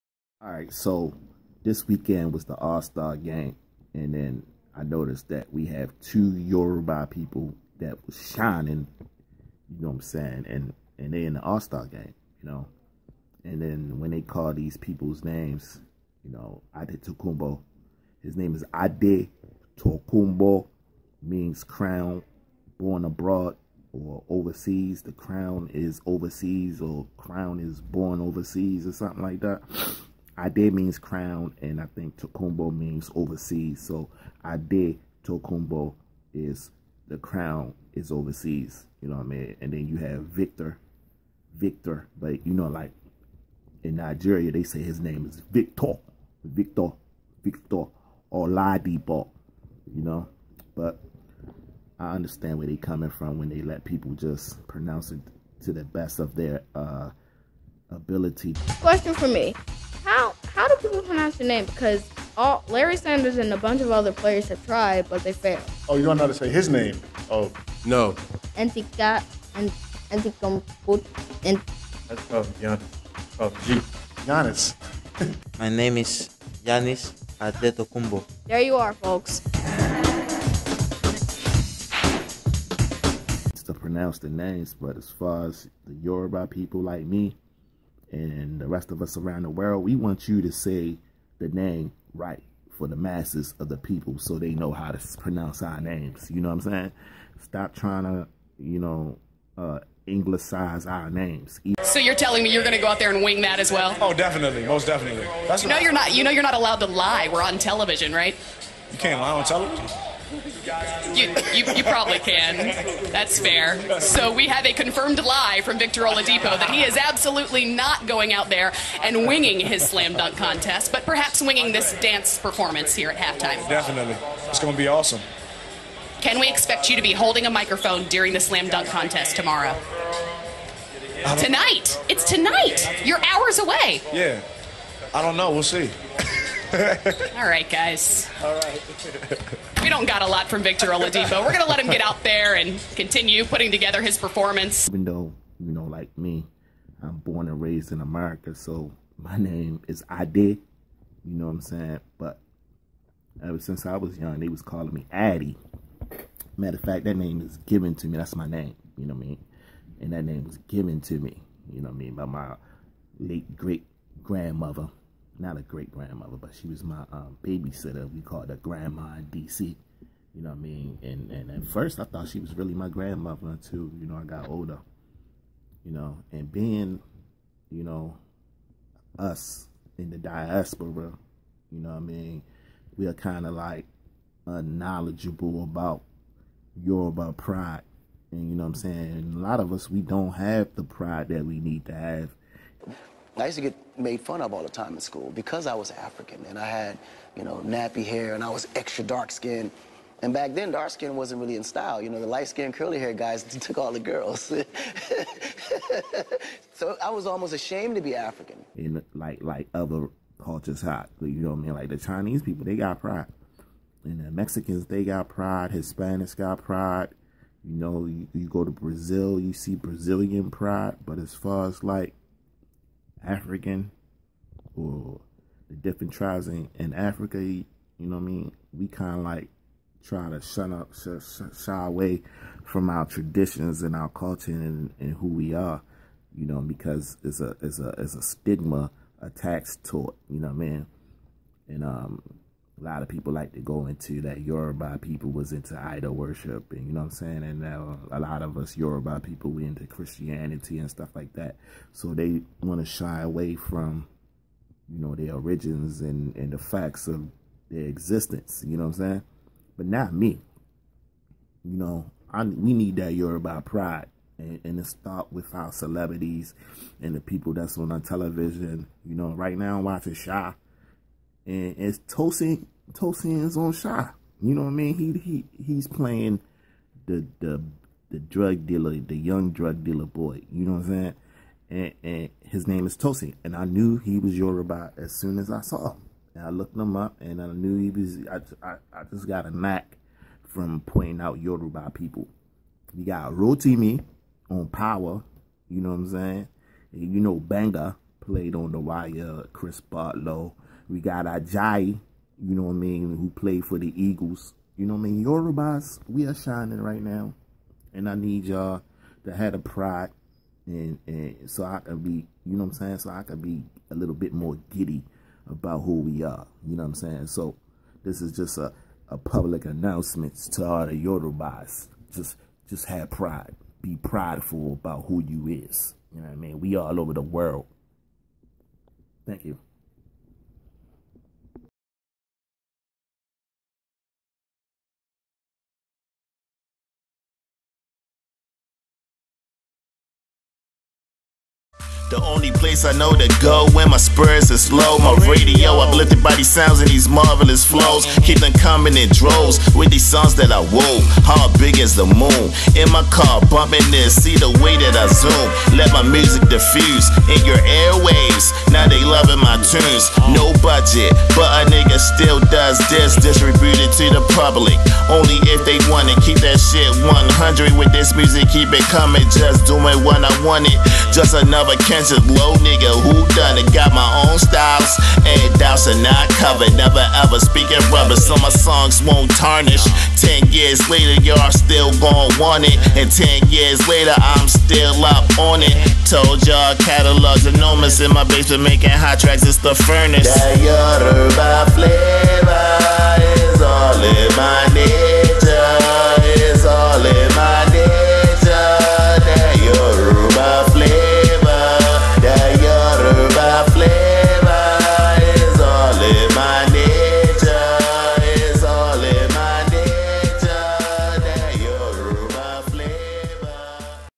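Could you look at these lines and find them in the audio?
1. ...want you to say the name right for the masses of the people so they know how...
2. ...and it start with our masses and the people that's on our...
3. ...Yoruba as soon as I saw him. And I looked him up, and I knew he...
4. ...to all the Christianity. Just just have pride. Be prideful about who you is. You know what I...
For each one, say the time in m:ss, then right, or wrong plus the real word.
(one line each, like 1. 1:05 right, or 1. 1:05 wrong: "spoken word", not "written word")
1. 1:29 right
2. 4:24 wrong: "celebrities", not "masses"
3. 4:44 right
4. 5:20 wrong: "Yorubas", not "Christianity".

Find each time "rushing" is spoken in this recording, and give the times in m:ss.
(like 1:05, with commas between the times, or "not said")
not said.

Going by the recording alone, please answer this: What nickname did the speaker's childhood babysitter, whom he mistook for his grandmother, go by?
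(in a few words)
Grandma DC.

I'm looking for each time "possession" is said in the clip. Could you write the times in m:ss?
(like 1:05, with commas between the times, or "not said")
not said.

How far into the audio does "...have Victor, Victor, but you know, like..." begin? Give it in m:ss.
0:39.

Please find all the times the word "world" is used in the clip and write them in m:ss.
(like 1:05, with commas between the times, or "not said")
1:29, 5:27.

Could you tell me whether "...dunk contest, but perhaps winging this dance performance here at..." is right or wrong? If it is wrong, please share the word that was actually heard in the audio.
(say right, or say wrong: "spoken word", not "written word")
right.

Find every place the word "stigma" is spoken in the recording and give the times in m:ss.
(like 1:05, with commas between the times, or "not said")
3:58.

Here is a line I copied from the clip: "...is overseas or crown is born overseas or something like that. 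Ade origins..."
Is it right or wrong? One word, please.
wrong.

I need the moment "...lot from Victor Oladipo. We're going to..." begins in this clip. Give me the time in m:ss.
2:20.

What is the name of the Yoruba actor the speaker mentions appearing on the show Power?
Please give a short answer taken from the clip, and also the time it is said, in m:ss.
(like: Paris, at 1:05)
Rotimi, at 4:53.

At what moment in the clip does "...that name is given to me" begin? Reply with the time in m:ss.
2:37.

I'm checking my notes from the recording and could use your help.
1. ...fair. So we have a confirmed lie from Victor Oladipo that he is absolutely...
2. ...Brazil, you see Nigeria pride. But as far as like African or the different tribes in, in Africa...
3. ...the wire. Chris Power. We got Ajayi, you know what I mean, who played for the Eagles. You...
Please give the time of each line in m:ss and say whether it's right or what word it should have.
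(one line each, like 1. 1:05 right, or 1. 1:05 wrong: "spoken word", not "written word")
1. 1:53 right
2. 3:38 wrong: "Brazilian", not "Nigeria"
3. 4:58 wrong: "Partlow", not "Power".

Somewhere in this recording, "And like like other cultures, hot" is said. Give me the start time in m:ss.
3:28.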